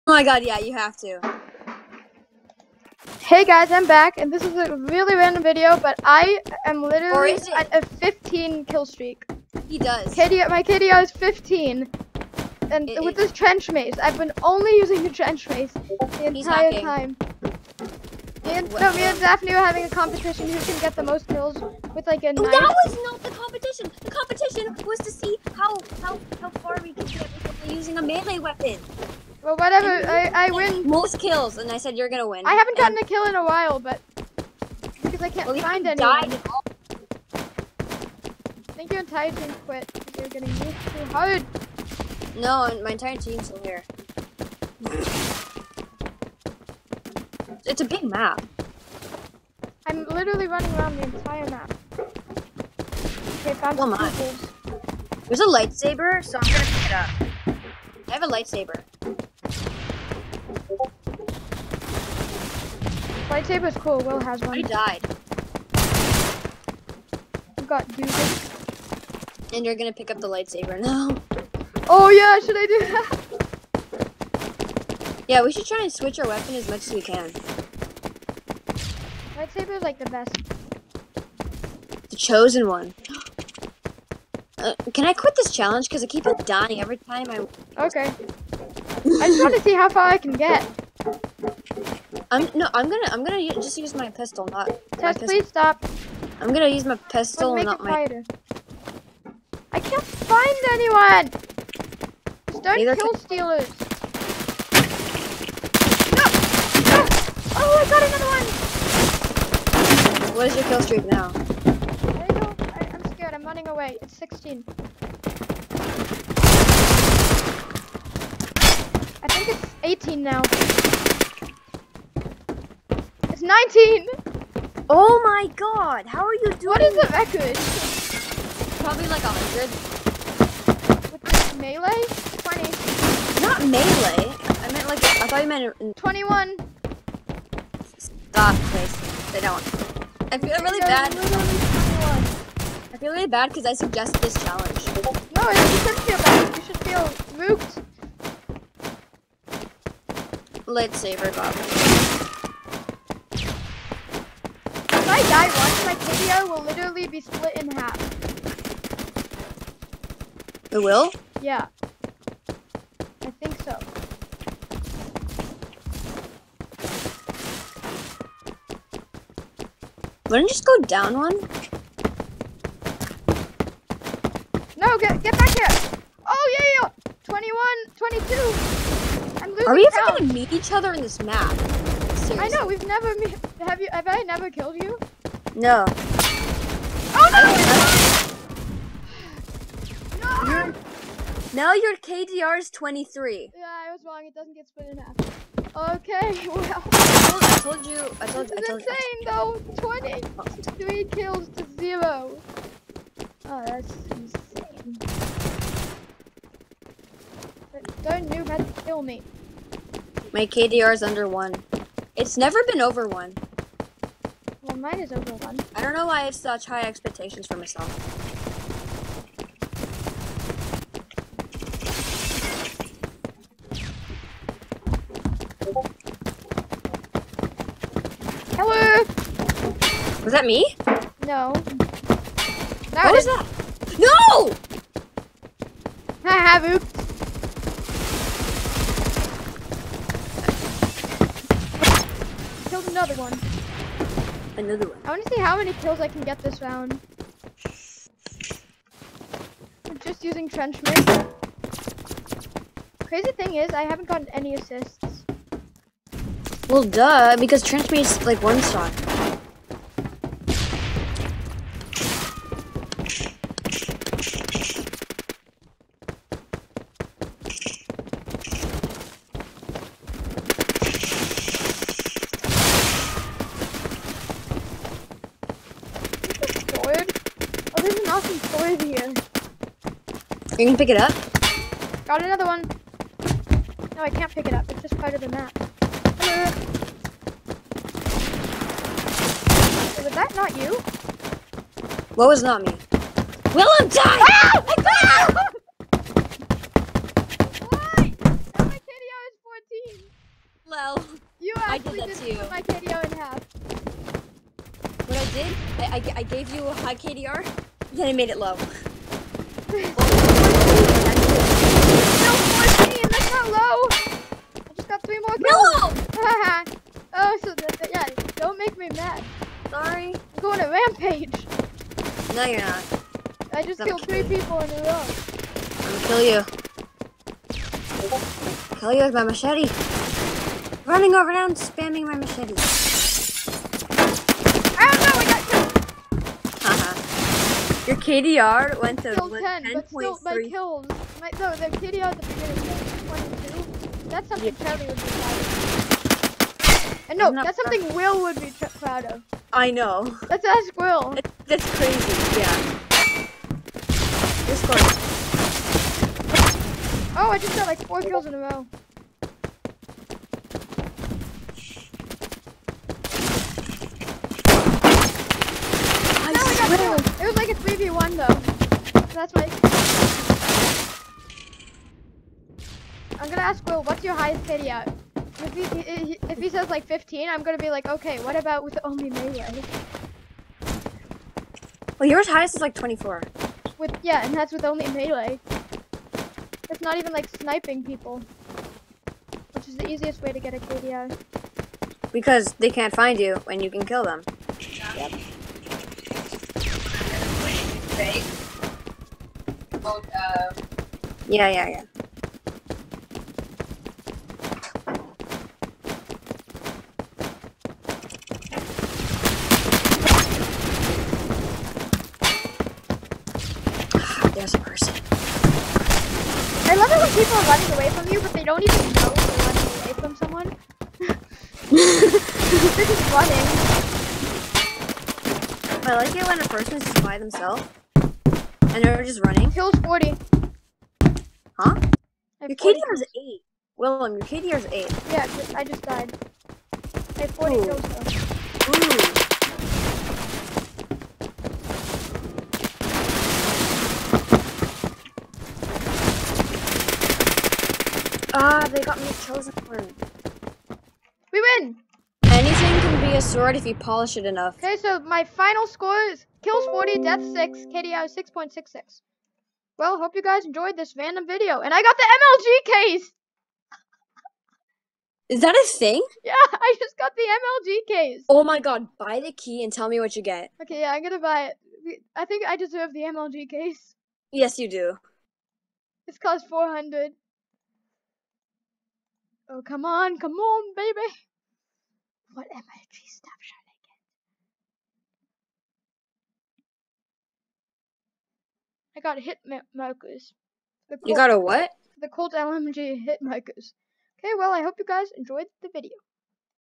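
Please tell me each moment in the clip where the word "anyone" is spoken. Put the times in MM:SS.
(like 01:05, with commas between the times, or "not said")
01:40.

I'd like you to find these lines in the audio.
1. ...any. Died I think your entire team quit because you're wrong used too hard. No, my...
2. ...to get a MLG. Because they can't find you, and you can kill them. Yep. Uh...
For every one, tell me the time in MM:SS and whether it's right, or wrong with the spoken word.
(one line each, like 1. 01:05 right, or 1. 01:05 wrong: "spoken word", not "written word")
1. 00:35 wrong: "getting", not "wrong"
2. 06:30 wrong: "KDR", not "MLG".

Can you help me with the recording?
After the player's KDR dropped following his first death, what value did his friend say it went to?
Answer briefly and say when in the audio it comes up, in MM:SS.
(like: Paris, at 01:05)
10.3, at 05:39.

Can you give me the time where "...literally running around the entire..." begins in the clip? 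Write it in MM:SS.
00:50.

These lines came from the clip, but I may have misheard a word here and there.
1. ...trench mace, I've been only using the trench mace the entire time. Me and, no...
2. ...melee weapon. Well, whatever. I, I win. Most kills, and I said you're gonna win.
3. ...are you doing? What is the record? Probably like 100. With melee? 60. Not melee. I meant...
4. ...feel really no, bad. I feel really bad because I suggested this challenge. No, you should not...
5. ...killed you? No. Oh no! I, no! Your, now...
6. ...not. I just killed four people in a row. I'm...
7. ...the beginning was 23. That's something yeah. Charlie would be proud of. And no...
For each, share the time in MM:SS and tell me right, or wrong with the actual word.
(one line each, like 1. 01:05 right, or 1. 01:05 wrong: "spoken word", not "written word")
1. 00:13 right
2. 00:28 right
3. 02:06 wrong: "20", not "60"
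4. 02:20 right
5. 03:04 right
6. 05:22 wrong: "three", not "four"
7. 05:42 wrong: "22", not "23".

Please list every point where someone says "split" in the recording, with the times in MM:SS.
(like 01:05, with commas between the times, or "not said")
02:37, 03:14.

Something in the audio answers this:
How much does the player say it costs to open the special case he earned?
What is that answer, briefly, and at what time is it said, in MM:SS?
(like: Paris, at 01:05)
400, at 07:56.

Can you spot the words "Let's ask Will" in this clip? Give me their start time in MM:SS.
05:50.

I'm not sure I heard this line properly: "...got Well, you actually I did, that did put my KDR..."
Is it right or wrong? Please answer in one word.
right.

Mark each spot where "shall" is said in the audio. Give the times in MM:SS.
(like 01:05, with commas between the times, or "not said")
08:03.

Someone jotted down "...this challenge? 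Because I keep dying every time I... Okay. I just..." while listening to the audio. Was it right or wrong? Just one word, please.
right.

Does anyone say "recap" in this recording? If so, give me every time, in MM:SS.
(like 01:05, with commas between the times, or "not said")
not said.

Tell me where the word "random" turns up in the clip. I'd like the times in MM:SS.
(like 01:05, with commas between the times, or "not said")
00:05, 07:40.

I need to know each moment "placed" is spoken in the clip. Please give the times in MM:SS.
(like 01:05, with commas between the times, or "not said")
not said.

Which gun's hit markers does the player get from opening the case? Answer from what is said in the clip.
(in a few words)
Colt LMG.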